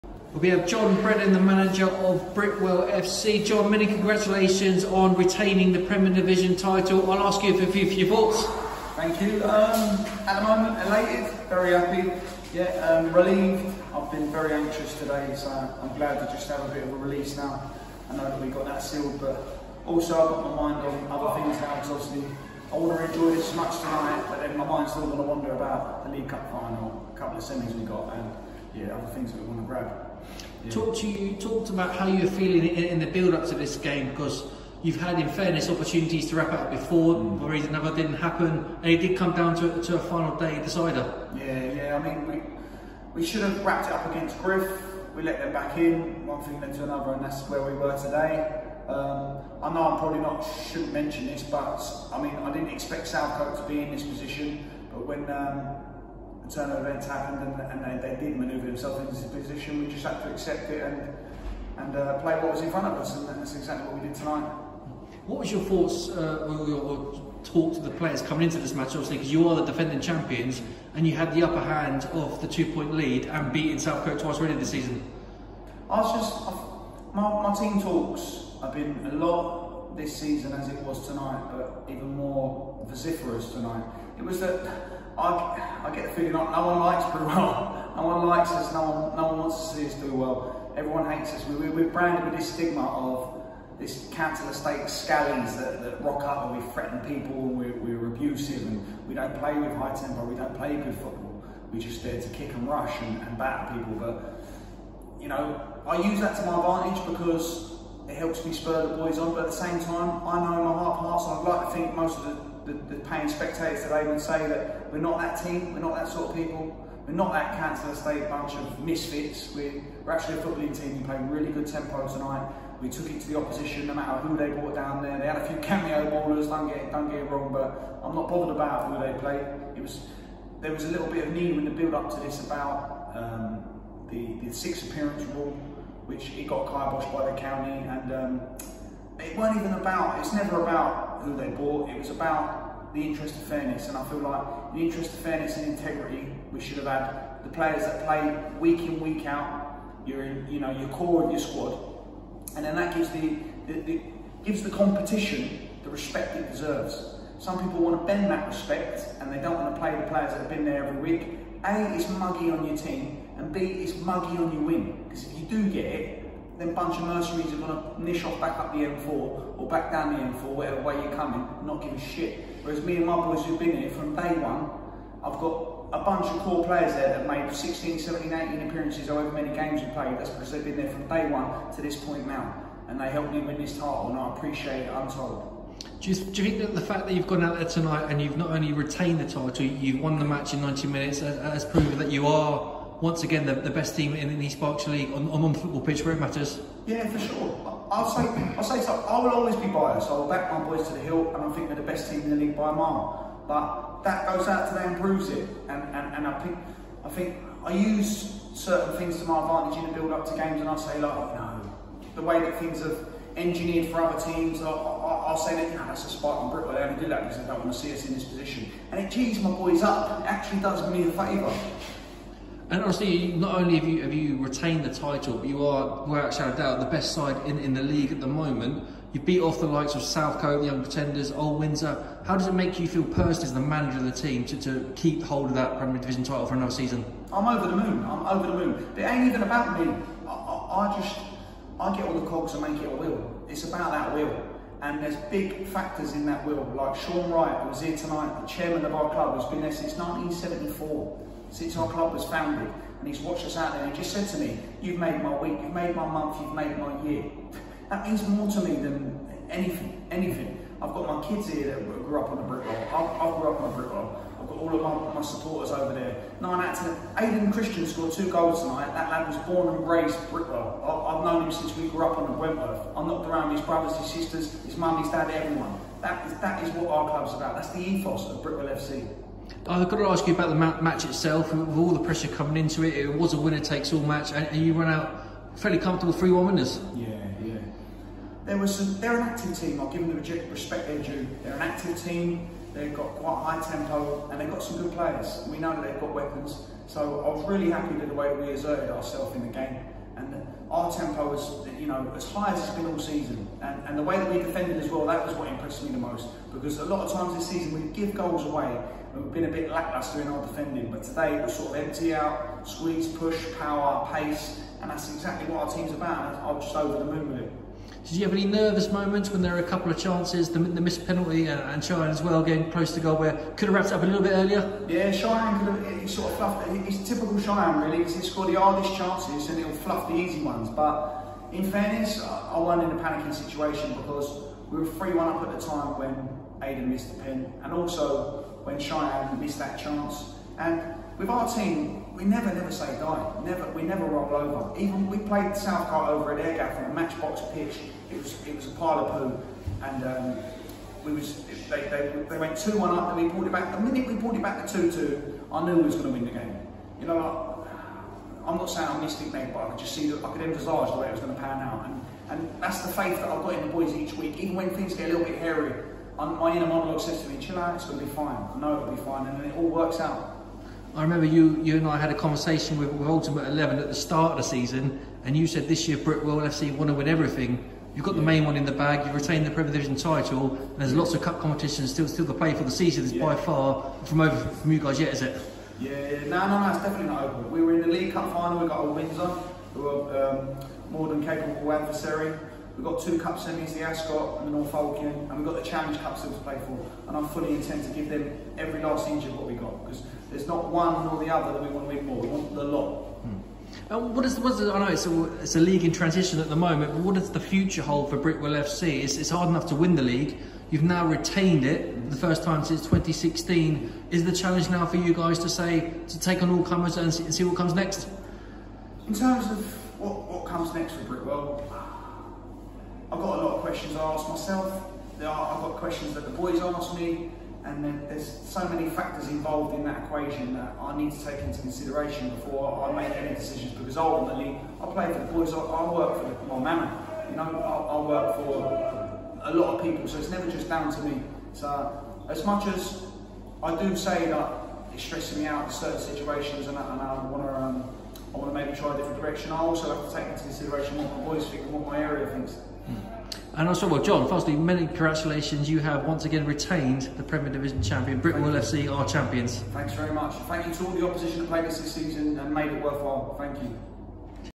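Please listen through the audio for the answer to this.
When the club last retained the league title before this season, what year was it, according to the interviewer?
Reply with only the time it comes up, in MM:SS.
06:52.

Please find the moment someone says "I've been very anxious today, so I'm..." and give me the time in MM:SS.
00:13.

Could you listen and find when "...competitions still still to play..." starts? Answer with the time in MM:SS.
06:21.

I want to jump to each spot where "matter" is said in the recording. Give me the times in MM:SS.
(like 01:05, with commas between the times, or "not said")
02:03, 03:16.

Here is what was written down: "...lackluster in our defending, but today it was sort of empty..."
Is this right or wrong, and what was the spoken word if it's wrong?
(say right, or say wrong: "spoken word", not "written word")
right.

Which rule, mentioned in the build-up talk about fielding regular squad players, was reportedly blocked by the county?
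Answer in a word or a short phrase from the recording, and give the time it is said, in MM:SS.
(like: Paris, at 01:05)
six appearance rule, at 02:14.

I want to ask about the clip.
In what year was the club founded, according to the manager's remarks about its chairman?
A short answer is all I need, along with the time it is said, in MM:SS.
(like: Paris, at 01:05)
1974, at 04:09.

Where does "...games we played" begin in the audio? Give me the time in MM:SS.
02:59.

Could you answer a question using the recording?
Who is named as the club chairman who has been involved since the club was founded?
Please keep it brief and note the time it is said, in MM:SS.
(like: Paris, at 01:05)
Sean Wright, at 04:06.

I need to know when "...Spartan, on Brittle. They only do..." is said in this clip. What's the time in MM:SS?
03:36.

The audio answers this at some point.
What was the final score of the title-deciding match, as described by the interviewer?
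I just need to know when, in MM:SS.
04:46.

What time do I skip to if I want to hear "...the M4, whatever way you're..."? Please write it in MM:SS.
02:50.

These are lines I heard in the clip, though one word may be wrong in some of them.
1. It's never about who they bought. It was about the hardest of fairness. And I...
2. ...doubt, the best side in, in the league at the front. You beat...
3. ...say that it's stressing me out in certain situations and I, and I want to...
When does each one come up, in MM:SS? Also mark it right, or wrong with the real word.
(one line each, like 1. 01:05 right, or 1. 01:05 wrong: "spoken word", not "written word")
1. 02:20 wrong: "interest", not "hardest"
2. 03:46 wrong: "moment", not "front"
3. 07:23 right.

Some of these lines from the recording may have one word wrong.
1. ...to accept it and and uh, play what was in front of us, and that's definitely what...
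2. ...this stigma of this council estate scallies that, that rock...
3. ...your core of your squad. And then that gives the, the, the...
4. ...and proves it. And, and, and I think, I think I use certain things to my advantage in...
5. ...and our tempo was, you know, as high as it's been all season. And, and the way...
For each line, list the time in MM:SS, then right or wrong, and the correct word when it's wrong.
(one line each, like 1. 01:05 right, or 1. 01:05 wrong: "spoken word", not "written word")
1. 01:00 wrong: "exactly", not "definitely"
2. 01:32 right
3. 02:30 right
4. 03:24 right
5. 05:00 right.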